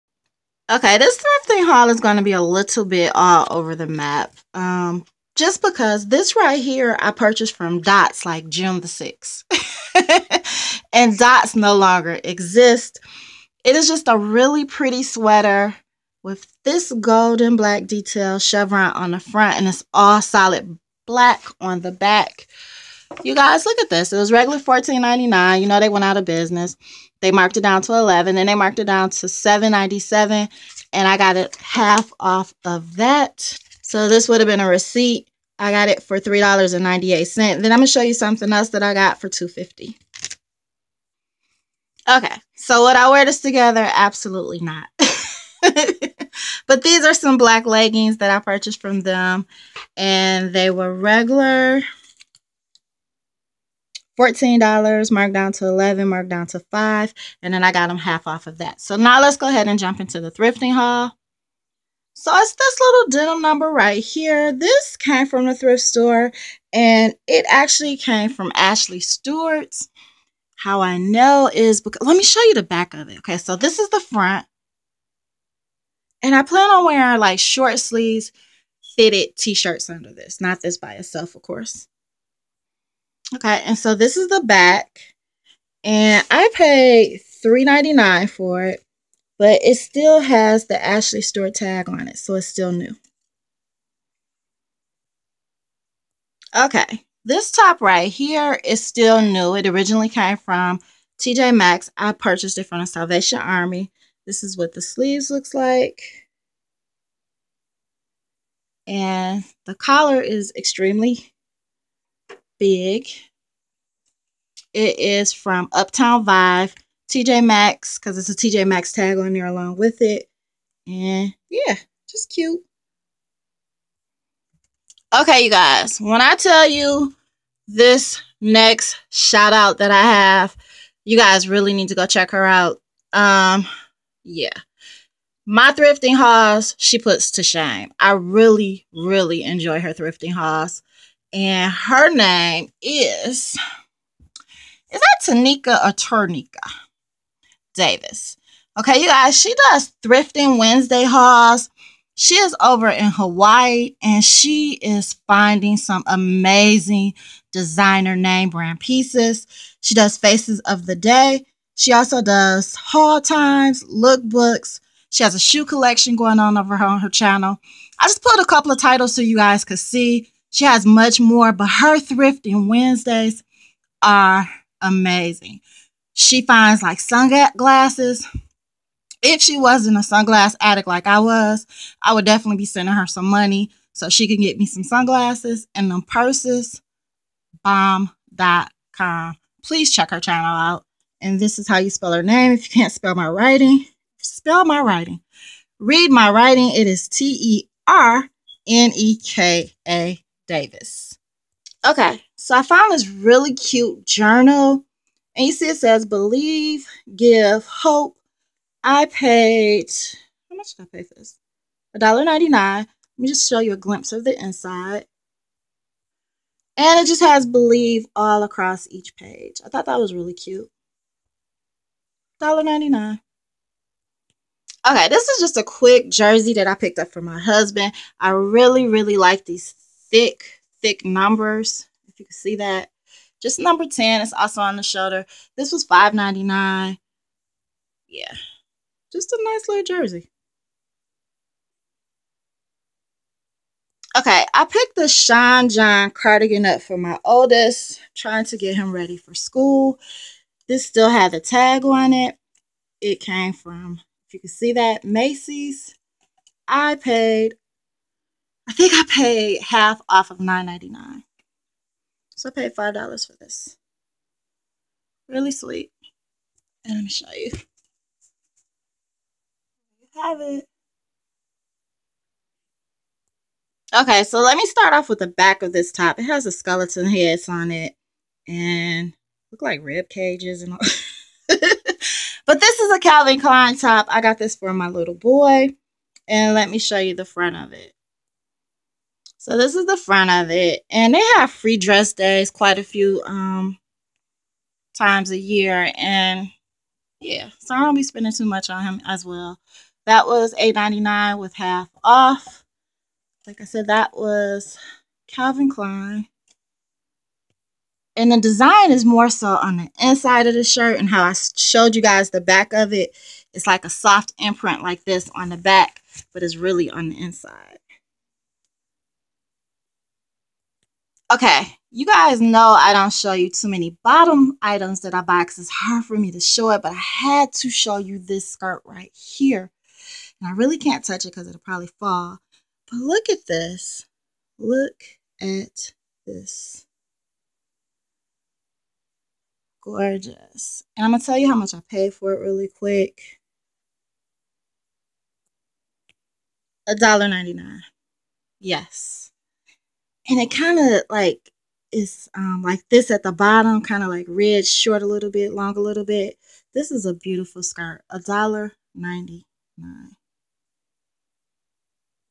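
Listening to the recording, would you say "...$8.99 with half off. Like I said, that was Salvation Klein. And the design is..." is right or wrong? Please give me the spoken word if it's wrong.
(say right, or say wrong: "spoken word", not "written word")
wrong: "Calvin", not "Salvation".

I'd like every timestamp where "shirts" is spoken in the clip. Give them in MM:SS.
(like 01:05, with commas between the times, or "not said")
01:19, 05:10.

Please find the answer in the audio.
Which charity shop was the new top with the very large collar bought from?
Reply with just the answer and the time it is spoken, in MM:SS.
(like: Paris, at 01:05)
Salvation Army, at 01:42.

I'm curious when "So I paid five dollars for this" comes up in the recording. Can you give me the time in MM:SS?
04:22.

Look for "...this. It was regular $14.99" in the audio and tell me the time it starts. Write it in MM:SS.
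00:23.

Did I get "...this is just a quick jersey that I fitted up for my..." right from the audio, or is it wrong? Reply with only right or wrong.
wrong.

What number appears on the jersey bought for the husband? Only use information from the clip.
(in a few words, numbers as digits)
10.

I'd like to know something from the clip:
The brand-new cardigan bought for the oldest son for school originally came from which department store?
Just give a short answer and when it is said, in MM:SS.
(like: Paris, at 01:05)
Macy's, at 04:15.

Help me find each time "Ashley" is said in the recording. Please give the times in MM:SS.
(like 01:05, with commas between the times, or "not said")
01:08, 01:30.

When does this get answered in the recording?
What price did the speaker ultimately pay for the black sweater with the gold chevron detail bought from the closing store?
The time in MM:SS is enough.
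00:36.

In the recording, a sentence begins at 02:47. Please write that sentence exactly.
I just put a couple of titles so you guys could see she has much more, but her thrifting Wednesdays are amazing.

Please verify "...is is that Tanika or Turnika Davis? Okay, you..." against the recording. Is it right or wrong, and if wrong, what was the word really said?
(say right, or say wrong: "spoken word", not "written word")
right.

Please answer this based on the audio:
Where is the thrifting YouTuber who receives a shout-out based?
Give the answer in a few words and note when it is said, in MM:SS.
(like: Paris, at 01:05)
Hawaii, at 02:33.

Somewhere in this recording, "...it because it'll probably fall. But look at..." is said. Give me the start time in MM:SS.
05:31.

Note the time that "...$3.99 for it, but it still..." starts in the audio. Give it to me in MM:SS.
01:27.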